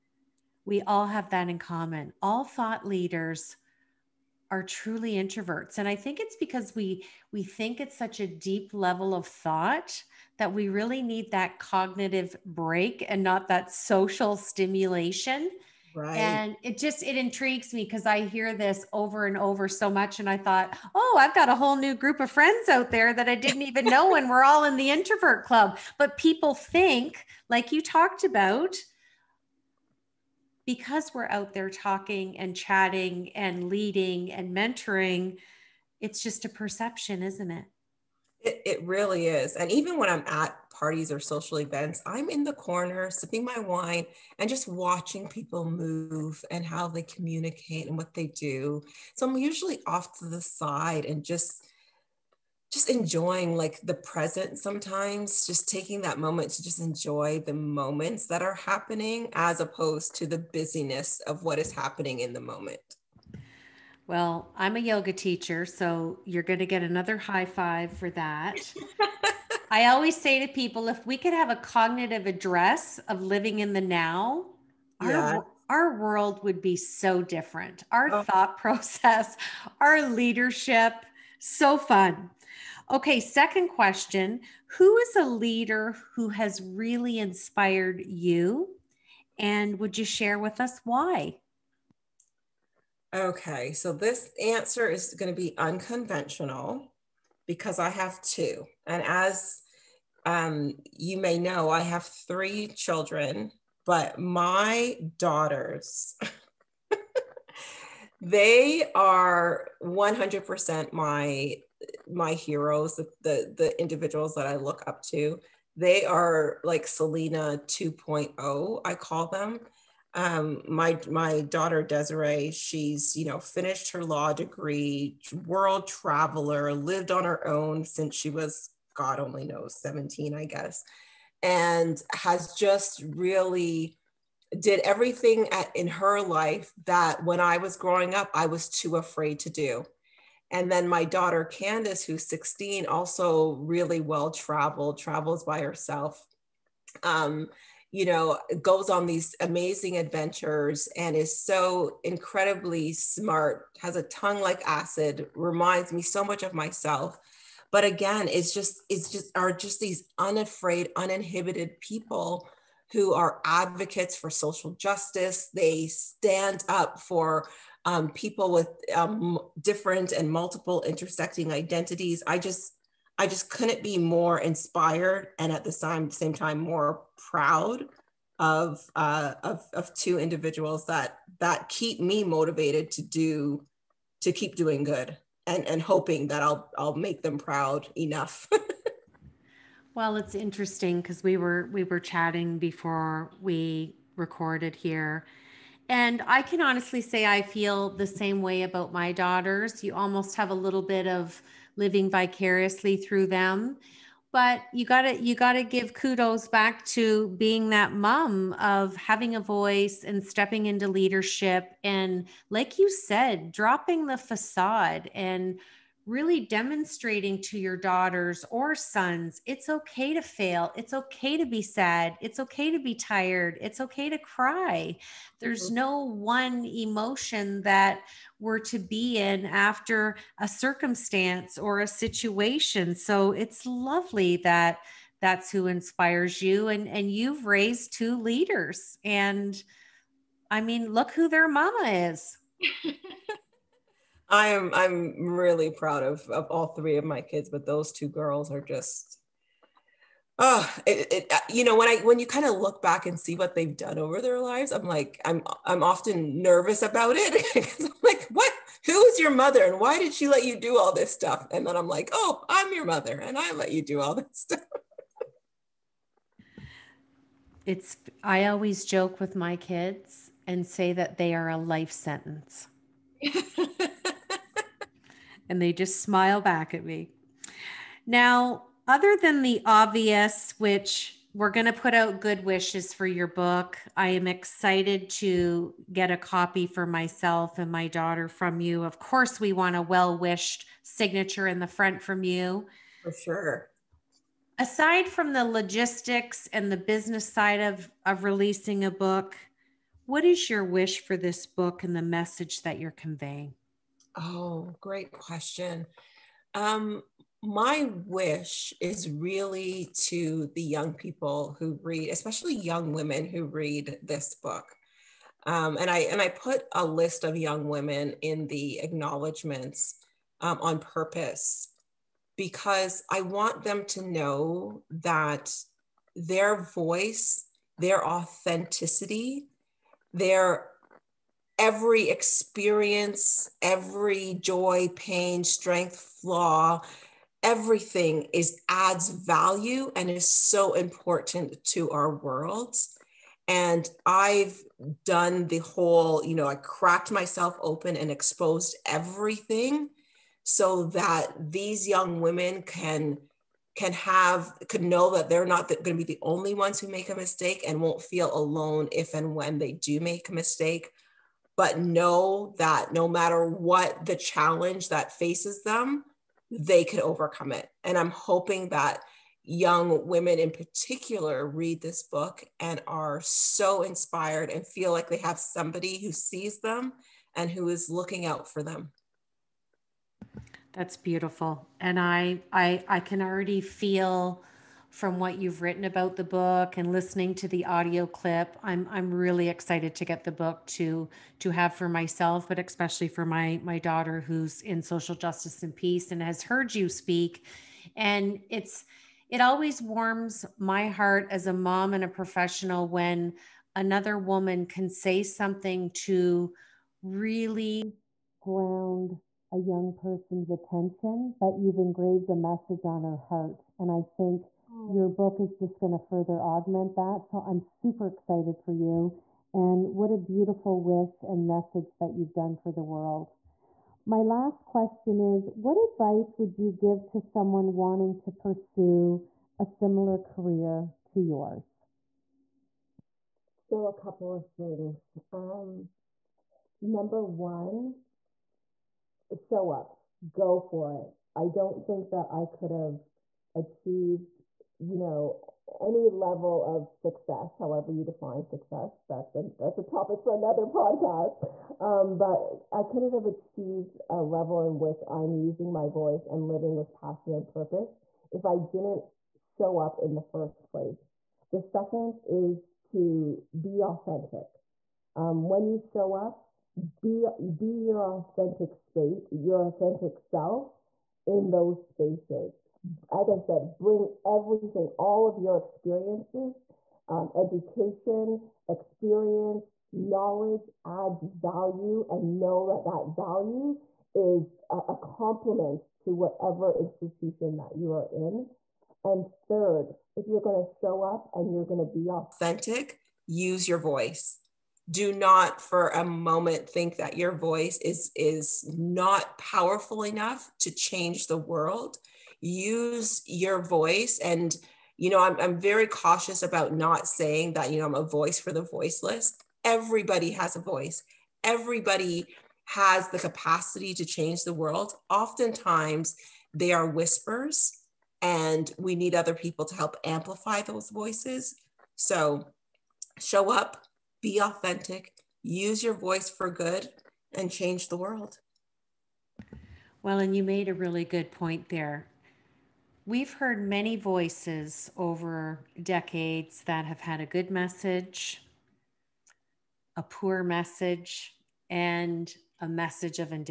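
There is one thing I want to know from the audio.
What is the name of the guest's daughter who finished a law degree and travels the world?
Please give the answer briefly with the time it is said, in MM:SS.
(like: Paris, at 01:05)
Desiree, at 02:01.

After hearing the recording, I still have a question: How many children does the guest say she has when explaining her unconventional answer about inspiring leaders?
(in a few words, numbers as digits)
3.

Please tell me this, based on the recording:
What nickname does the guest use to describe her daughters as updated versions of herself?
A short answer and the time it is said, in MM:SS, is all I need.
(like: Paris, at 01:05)
Celina 2.0, at 01:56.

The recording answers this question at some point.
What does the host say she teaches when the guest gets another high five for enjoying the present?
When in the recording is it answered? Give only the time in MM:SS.
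01:04.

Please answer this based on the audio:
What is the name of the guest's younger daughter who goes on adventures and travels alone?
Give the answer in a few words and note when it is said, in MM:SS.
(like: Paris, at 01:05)
Candace, at 02:21.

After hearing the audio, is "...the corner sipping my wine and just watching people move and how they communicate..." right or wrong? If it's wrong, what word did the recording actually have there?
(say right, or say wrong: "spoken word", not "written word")
right.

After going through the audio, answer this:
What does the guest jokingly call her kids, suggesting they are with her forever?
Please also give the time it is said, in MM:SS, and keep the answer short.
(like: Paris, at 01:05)
A life sentence, at 04:31.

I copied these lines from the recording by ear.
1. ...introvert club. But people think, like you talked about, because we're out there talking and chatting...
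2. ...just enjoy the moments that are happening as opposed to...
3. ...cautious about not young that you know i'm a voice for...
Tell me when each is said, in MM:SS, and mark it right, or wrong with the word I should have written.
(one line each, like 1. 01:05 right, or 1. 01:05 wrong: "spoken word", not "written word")
1. 00:24 right
2. 00:56 right
3. 08:25 wrong: "saying", not "young".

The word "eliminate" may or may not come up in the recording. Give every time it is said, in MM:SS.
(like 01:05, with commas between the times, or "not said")
not said.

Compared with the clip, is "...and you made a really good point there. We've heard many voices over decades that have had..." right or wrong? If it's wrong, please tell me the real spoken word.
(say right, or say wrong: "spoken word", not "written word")
right.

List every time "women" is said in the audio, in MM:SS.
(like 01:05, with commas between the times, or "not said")
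05:12, 05:17, 05:52, 06:10.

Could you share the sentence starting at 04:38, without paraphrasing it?
Now, other than the obvious, which we're going to put out good wishes for your book.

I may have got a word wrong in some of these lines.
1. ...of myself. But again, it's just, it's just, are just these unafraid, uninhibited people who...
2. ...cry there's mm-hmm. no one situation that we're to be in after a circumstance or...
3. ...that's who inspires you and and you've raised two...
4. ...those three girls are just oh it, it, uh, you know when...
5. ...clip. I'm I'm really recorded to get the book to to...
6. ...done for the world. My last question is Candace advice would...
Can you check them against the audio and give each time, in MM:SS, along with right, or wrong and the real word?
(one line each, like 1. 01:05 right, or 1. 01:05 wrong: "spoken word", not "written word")
1. 02:36 right
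2. 03:44 wrong: "emotion", not "situation"
3. 03:55 right
4. 04:07 wrong: "two", not "three"
5. 06:28 wrong: "excited", not "recorded"
6. 07:02 wrong: "What", not "Candace".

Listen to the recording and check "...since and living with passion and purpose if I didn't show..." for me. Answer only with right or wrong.
wrong.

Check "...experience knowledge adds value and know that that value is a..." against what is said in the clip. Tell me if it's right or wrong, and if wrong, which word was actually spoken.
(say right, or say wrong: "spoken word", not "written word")
right.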